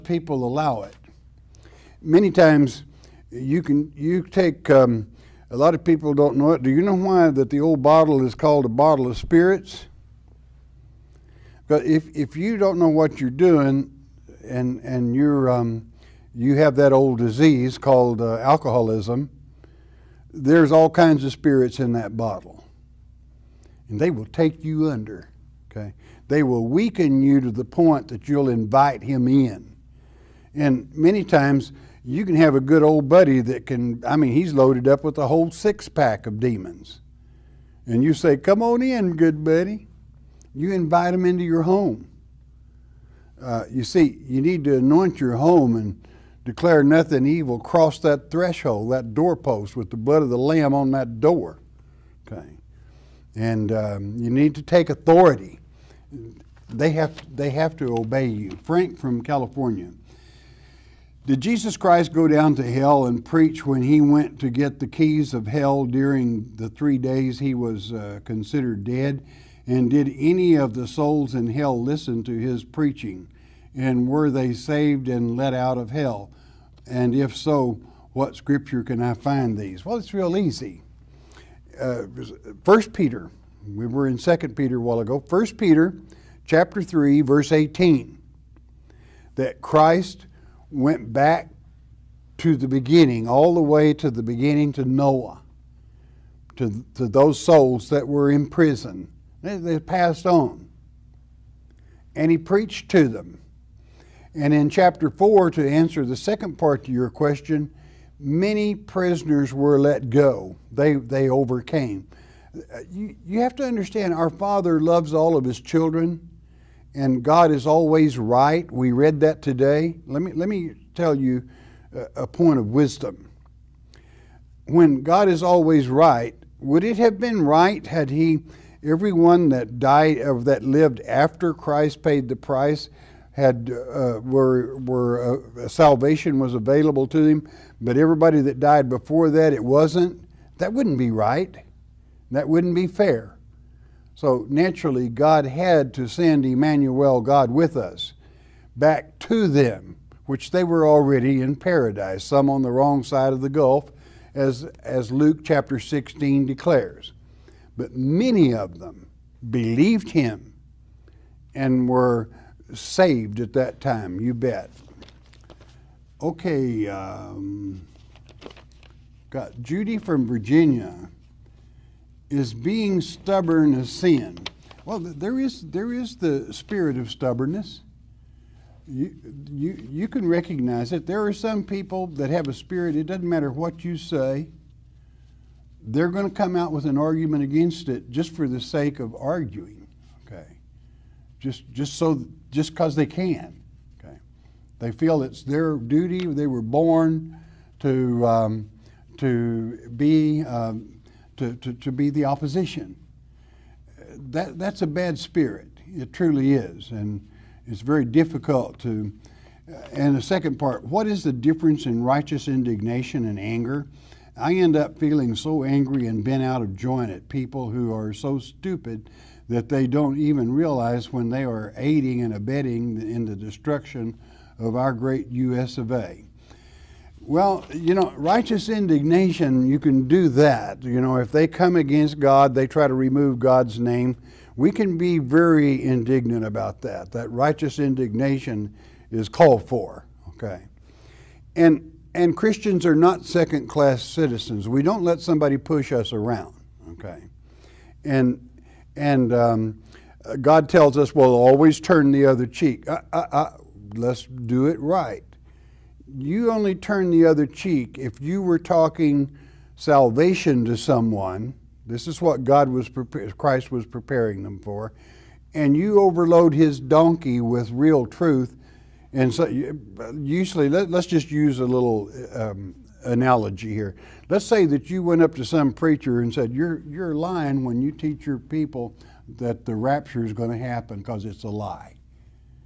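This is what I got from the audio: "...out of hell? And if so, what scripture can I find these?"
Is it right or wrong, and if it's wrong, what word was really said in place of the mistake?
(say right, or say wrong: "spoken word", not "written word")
right.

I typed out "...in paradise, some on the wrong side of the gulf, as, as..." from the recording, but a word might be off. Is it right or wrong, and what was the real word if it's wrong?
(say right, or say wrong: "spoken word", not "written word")
right.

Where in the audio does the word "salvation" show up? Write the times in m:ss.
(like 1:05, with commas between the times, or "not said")
2:15, 4:19.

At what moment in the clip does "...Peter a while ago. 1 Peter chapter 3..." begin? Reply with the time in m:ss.
1:24.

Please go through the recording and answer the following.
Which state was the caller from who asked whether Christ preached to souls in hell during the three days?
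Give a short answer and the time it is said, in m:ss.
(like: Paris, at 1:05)
California, at 0:59.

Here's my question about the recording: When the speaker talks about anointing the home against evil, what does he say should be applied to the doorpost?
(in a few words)
The blood of the Lamb.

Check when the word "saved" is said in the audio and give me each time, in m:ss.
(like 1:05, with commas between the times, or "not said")
1:14, 2:42.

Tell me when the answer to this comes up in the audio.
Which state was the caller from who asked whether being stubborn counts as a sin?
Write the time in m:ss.
2:50.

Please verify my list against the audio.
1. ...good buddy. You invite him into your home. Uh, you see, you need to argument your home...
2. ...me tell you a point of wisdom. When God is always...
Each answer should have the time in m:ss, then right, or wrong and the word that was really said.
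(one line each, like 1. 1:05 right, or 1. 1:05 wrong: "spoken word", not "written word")
1. 0:39 wrong: "anoint", not "argument"
2. 2:00 right.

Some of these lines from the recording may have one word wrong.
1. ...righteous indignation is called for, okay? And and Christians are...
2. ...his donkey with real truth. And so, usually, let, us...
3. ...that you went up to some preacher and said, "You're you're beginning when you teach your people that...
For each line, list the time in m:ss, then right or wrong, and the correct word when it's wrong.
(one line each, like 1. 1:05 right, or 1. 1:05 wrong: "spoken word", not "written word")
1. 3:57 right
2. 4:26 right
3. 4:34 wrong: "lying", not "beginning".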